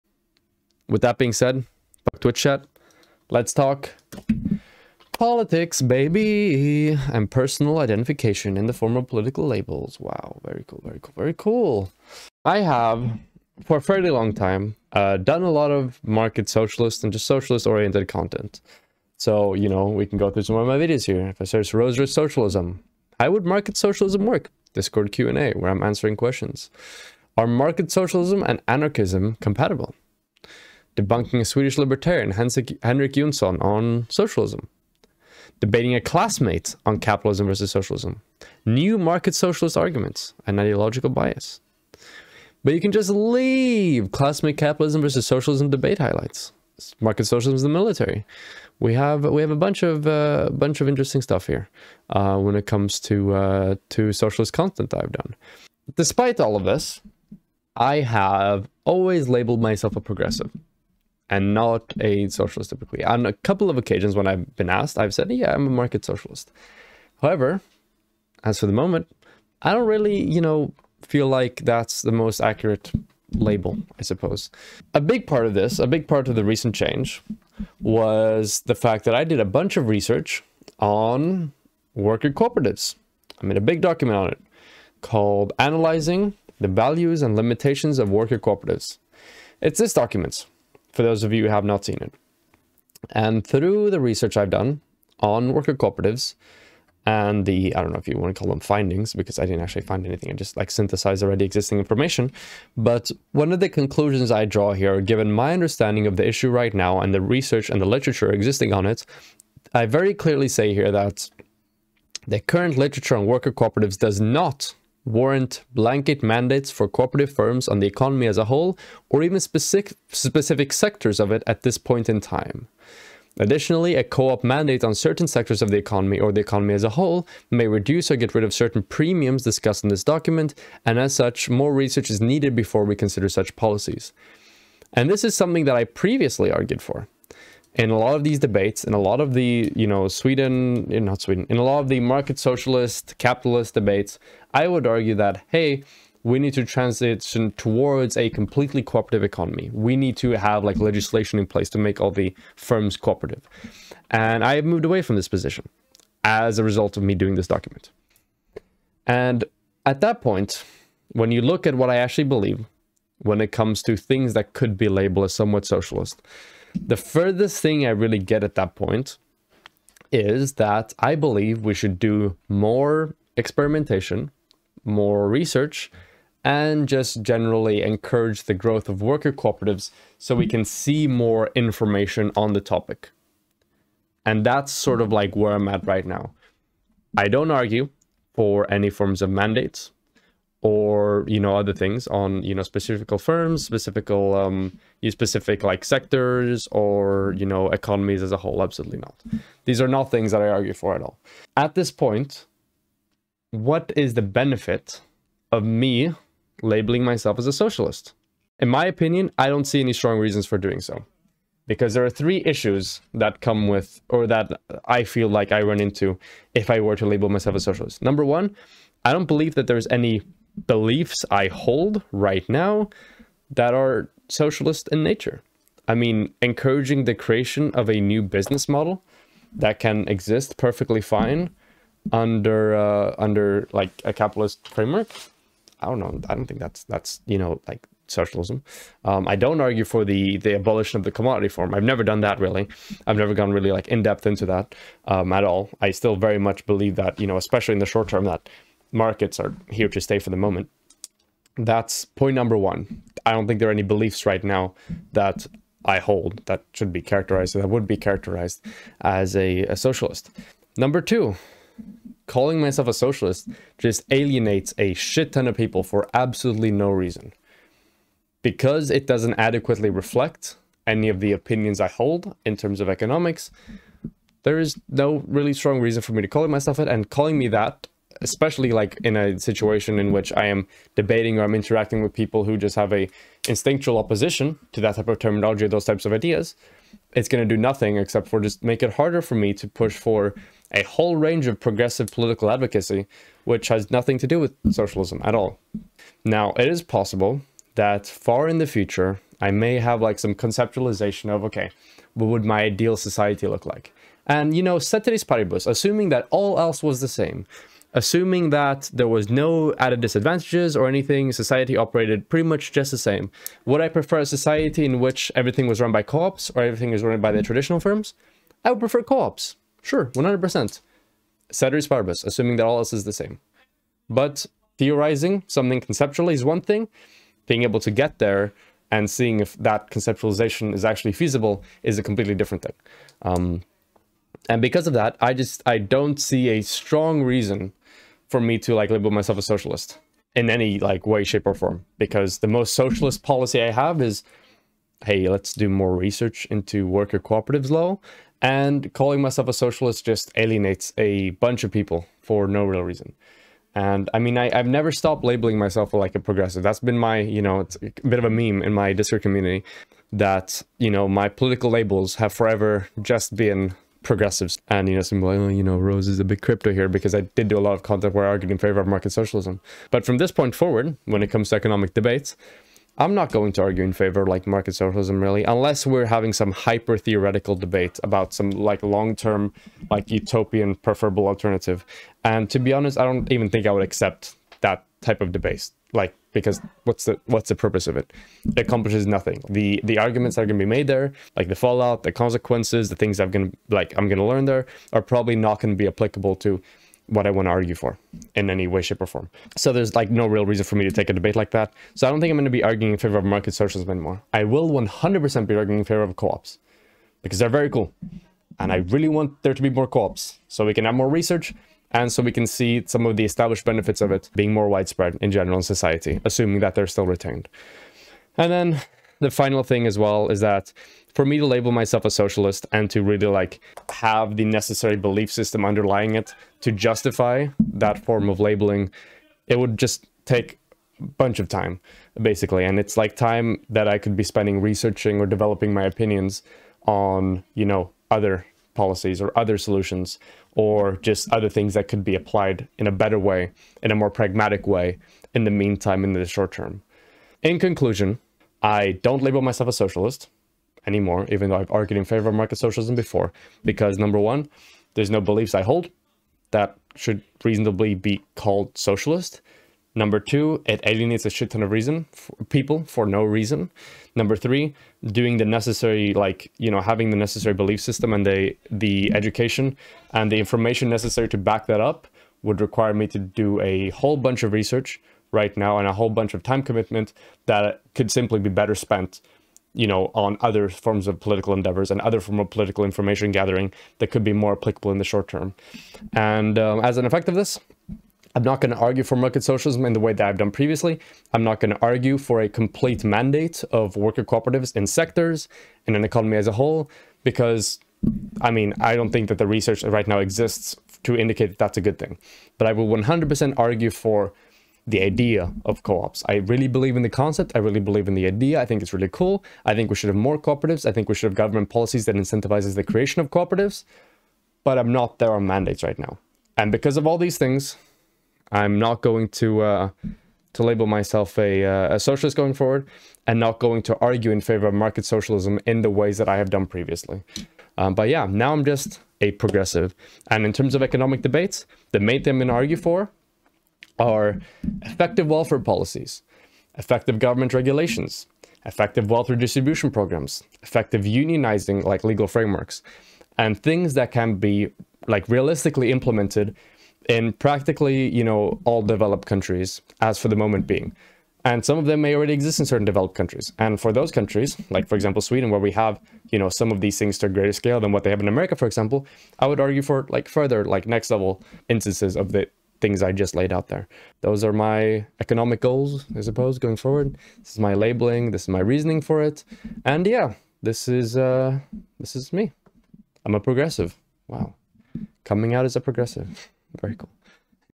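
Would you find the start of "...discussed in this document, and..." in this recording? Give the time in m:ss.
2:09.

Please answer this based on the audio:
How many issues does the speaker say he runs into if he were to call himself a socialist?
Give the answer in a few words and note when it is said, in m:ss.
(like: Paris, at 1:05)
3, at 3:32.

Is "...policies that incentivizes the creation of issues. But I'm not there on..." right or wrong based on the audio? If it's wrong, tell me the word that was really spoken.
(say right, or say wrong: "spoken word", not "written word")
wrong: "cooperatives", not "issues".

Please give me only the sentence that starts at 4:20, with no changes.
Number two, calling myself a socialist just alienates a shit ton of people for absolutely no reason.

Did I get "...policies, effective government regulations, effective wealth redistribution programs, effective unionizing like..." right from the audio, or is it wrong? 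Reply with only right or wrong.
right.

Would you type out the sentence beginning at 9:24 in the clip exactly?
Those are my economic goals, I suppose, going forward.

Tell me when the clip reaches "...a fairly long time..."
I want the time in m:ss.
0:13.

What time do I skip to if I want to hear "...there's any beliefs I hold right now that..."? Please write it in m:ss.
3:39.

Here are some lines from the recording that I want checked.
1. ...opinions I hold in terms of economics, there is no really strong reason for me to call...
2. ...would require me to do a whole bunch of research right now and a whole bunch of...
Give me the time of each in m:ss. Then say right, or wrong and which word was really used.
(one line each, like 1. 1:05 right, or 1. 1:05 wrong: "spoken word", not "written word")
1. 4:31 right
2. 7:52 right.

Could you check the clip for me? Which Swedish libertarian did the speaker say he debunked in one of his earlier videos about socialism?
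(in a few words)
Henrik Jonsson.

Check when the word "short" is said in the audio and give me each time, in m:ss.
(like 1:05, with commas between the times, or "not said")
4:07, 7:26, 8:05.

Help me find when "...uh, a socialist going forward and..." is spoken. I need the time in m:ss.
8:41.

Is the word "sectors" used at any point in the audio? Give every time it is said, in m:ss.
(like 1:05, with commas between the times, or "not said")
2:00, 2:05, 3:15, 8:14.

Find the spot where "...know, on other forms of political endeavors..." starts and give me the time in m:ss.
7:59.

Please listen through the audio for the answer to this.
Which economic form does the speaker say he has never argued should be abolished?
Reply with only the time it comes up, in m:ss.
4:01.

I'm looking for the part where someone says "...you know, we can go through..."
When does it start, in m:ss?
0:19.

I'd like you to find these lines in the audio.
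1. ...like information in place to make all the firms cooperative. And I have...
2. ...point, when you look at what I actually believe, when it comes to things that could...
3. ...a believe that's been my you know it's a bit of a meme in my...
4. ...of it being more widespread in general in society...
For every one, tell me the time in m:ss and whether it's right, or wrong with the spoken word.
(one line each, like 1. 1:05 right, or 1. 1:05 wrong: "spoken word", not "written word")
1. 2:30 wrong: "legislation", not "information"
2. 2:40 right
3. 5:56 wrong: "progressive", not "believe"
4. 6:54 right.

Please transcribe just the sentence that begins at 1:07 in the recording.
However, as for the moment, I don't really, you know, feel like that's the most accurate label, I suppose.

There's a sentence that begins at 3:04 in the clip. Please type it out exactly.
And that's sort of like where I'm at right now.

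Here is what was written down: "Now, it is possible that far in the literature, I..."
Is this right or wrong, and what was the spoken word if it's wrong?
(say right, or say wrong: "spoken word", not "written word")
wrong: "future", not "literature".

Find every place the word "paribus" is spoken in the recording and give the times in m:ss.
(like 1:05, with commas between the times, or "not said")
5:05, 5:21.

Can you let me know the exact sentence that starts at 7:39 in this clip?
Number two, it alienates a shit ton of reason for people for no reason.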